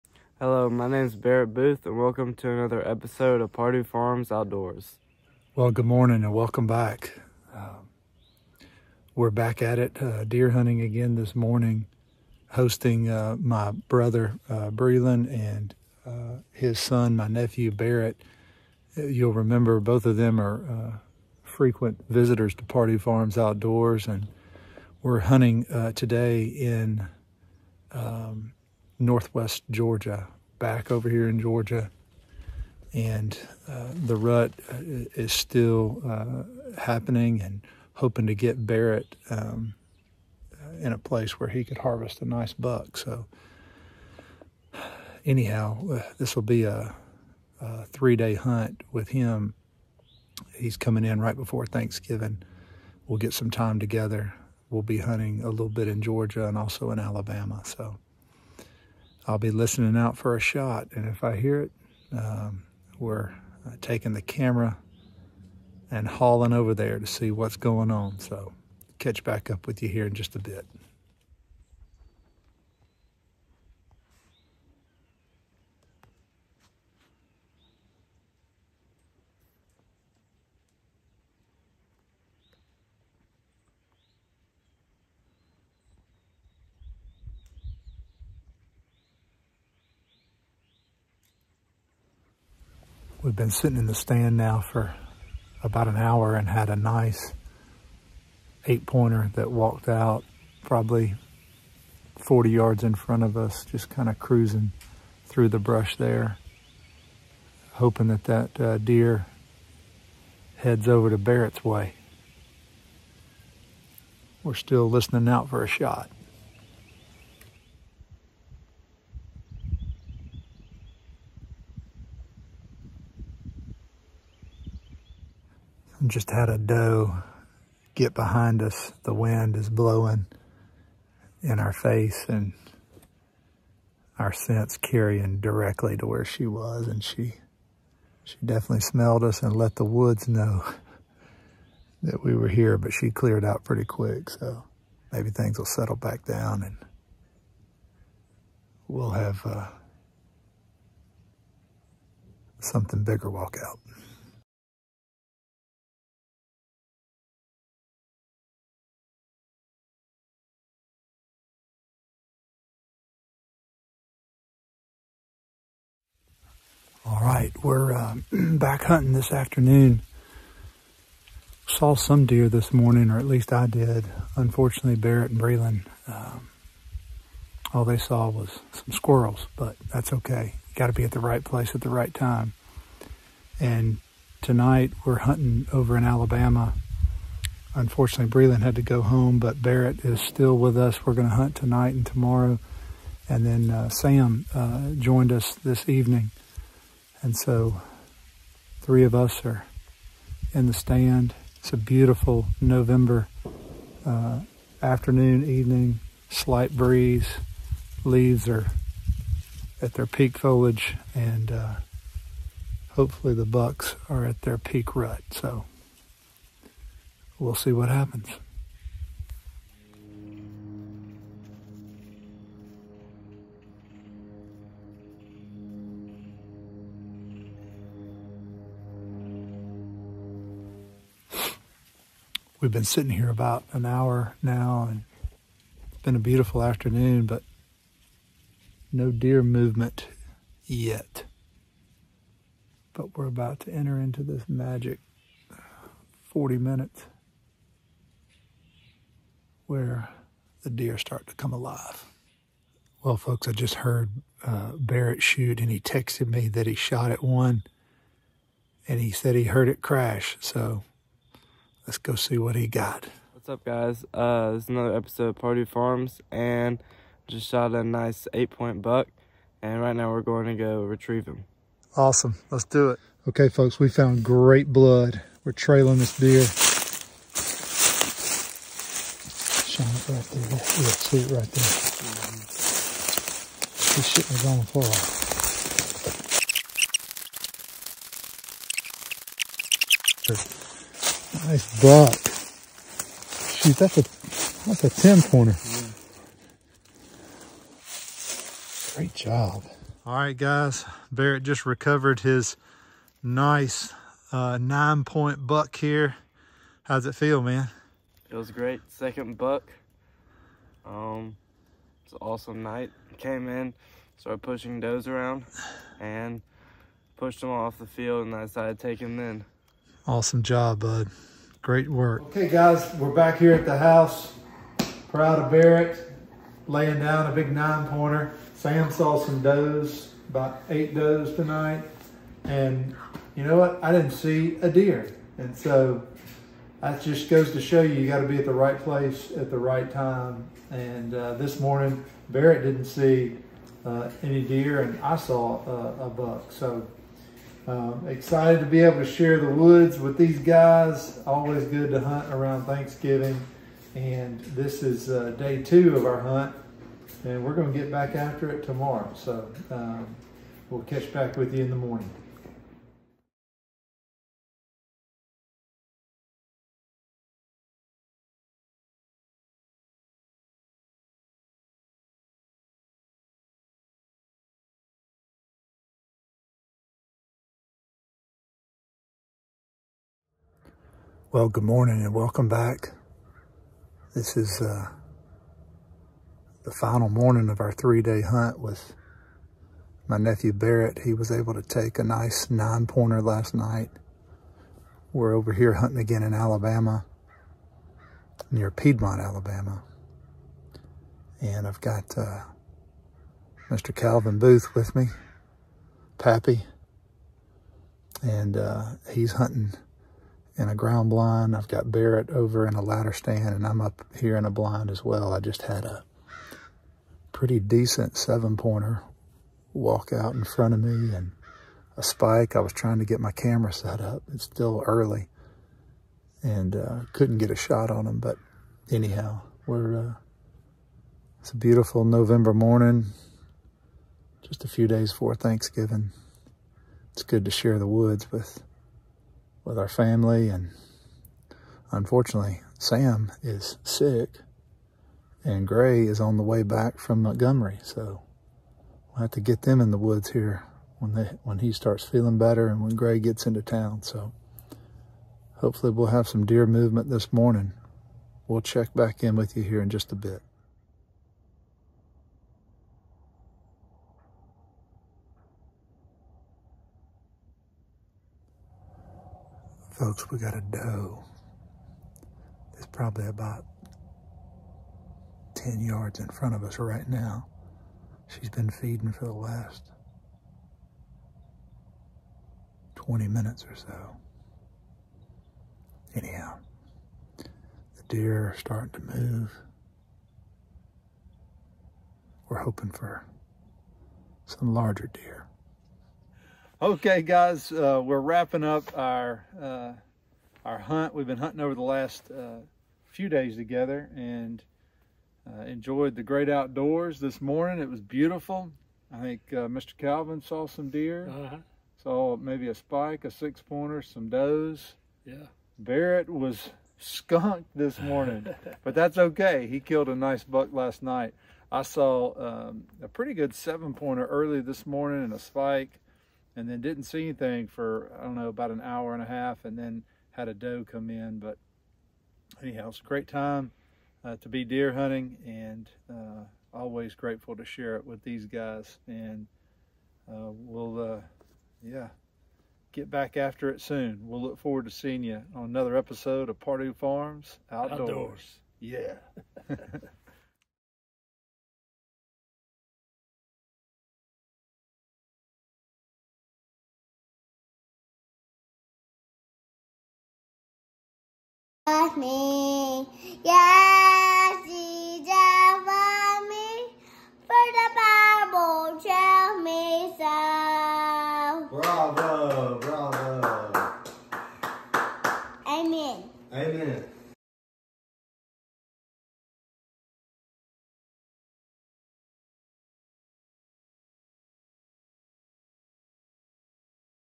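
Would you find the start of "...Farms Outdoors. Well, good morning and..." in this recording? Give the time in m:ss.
0:03.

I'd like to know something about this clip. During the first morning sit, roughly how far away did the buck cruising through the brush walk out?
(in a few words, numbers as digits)
40 yards.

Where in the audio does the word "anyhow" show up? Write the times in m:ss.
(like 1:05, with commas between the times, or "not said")
0:45, 7:08, 8:06, 8:52.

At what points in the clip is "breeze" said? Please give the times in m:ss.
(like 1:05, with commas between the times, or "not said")
3:26.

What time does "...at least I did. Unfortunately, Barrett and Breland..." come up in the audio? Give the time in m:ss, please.
2:53.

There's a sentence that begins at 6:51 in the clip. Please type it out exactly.
I've got Barrett over in a ladder stand, and I'm up here in a blind as well.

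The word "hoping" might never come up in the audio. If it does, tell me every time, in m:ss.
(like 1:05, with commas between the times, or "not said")
0:37, 1:47, 8:12.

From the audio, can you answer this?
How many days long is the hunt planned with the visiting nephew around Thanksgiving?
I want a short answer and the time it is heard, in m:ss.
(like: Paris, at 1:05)
3, at 0:47.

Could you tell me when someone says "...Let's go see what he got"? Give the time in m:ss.
4:21.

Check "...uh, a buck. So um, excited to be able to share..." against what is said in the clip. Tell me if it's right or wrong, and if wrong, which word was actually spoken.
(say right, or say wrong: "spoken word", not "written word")
right.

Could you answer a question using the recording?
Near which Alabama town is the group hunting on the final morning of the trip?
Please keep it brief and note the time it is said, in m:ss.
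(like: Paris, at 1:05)
Piedmont, Alabama, at 6:38.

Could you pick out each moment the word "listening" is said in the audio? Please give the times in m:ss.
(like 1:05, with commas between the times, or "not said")
0:59, 1:54.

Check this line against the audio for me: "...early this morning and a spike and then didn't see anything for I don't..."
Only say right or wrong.
right.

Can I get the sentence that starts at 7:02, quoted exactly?
I was trying to get my camera set up.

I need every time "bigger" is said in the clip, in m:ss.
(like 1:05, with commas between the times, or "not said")
2:33.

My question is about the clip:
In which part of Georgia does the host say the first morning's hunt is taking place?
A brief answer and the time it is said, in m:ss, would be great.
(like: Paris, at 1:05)
northwest Georgia, at 0:29.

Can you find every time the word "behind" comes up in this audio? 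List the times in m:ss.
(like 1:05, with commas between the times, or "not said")
2:08.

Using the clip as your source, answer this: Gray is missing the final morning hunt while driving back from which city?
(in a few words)
Montgomery.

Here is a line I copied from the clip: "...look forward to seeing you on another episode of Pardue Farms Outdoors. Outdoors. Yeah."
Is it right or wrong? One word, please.
right.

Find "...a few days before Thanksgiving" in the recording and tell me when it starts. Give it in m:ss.
7:14.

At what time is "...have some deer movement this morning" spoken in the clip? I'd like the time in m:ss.
7:36.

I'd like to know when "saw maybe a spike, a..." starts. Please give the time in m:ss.
8:32.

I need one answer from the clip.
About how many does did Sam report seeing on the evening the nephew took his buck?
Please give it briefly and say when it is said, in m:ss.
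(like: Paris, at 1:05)
8, at 5:30.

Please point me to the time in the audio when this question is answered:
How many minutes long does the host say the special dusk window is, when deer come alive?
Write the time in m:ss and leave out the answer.
4:06.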